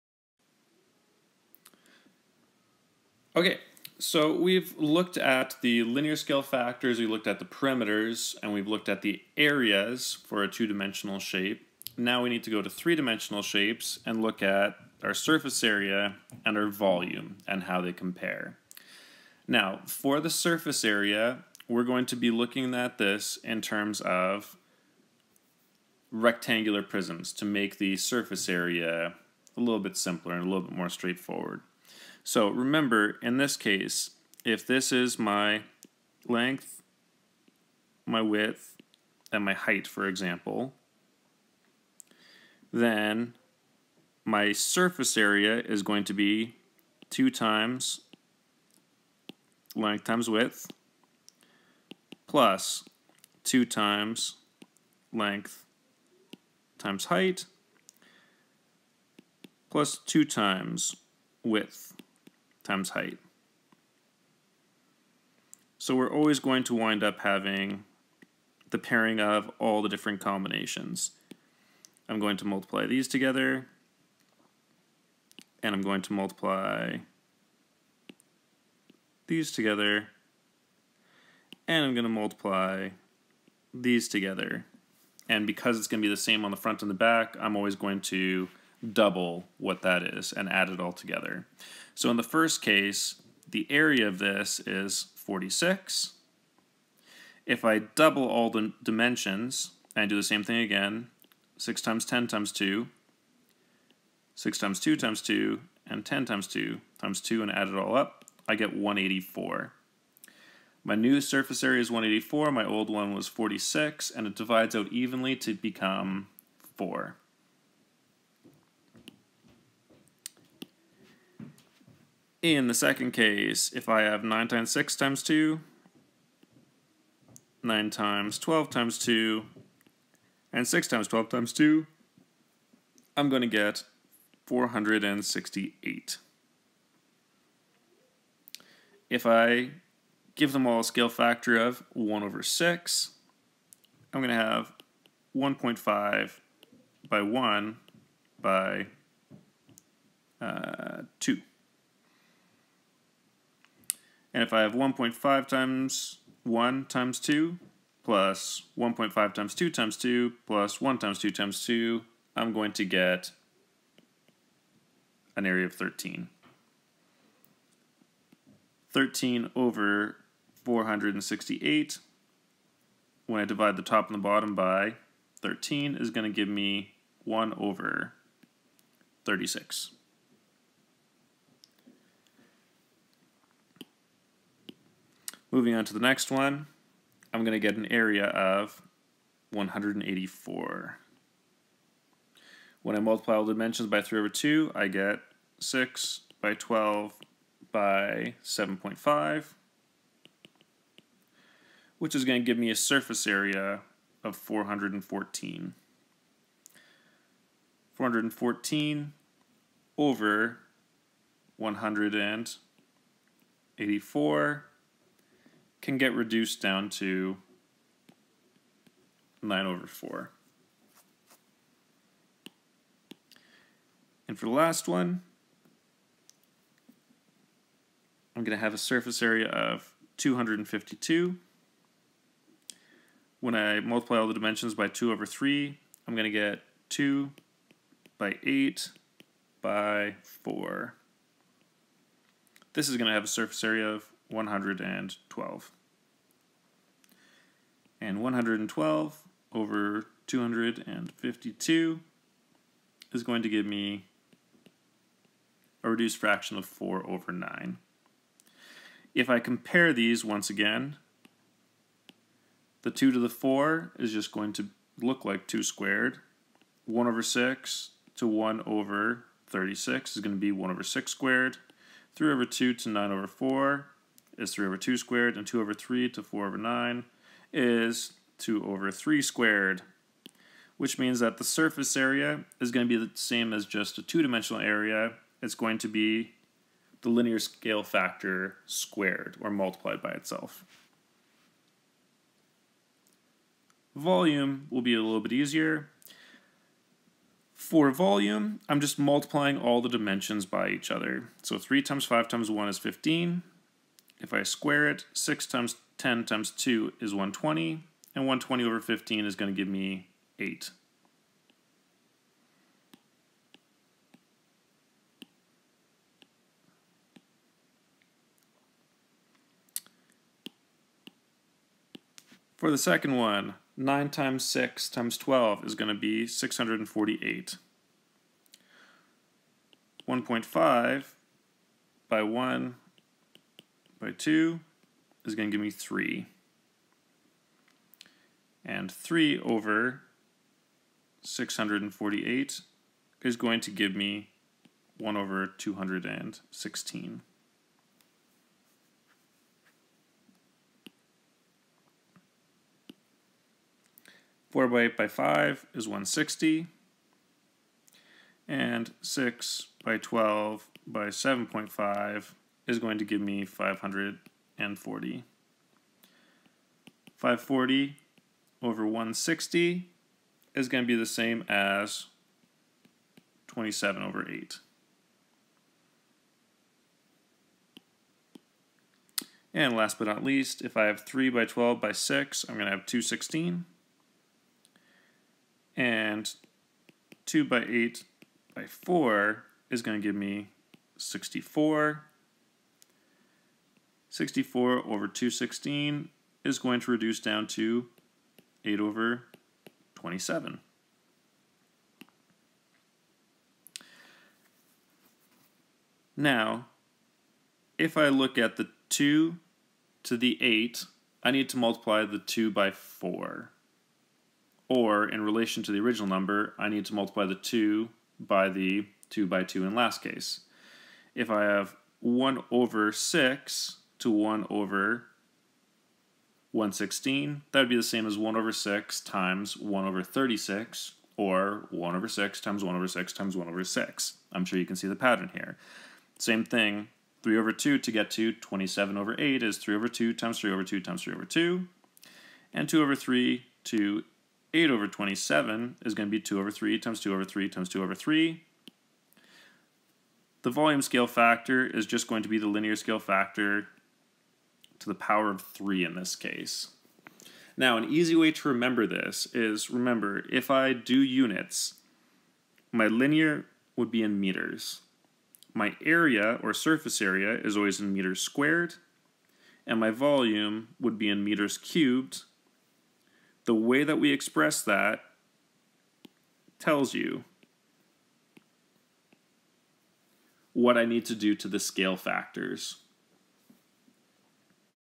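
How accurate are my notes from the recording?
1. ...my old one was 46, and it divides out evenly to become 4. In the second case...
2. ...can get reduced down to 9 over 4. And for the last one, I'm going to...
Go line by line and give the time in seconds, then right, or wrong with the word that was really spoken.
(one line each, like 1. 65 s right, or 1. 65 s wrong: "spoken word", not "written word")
1. 112 s right
2. 215 s right.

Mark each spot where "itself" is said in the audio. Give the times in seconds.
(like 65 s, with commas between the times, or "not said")
290 s.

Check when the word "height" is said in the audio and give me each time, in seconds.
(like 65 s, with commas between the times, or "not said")
39 s, 57 s, 62 s.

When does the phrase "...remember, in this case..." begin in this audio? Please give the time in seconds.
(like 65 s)
32 s.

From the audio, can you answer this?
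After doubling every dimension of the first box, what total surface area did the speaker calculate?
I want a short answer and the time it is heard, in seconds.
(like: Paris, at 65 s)
184, at 108 s.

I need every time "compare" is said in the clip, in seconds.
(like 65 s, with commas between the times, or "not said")
17 s, 259 s.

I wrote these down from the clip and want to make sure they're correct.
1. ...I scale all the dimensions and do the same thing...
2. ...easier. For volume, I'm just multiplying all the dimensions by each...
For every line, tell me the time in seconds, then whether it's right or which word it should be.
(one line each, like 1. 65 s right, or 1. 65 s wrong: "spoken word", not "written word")
1. 97 s wrong: "double", not "scale"
2. 295 s right.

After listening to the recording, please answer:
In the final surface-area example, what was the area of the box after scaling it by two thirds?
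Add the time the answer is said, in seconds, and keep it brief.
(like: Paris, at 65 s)
112, at 242 s.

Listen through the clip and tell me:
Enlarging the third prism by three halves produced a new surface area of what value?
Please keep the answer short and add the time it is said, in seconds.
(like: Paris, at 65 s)
414, at 202 s.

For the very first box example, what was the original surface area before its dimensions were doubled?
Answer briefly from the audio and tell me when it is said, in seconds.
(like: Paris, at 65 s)
46, at 93 s.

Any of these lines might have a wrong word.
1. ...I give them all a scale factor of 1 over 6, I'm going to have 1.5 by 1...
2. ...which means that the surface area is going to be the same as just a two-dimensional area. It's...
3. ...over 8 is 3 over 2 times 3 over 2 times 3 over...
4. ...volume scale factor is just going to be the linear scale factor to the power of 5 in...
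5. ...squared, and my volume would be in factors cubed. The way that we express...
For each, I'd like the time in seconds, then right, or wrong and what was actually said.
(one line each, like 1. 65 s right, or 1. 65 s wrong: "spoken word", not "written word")
1. 139 s right
2. 280 s right
3. 438 s right
4. 450 s wrong: "3", not "5"
5. 468 s wrong: "meters", not "factors".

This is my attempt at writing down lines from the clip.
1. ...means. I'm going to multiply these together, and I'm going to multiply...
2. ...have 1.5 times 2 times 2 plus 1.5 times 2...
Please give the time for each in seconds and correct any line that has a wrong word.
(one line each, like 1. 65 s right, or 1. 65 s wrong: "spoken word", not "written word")
1. 70 s wrong: "combinations", not "means"
2. 154 s wrong: "1", not "2".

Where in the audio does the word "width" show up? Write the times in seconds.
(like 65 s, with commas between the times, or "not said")
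38 s, 50 s, 61 s.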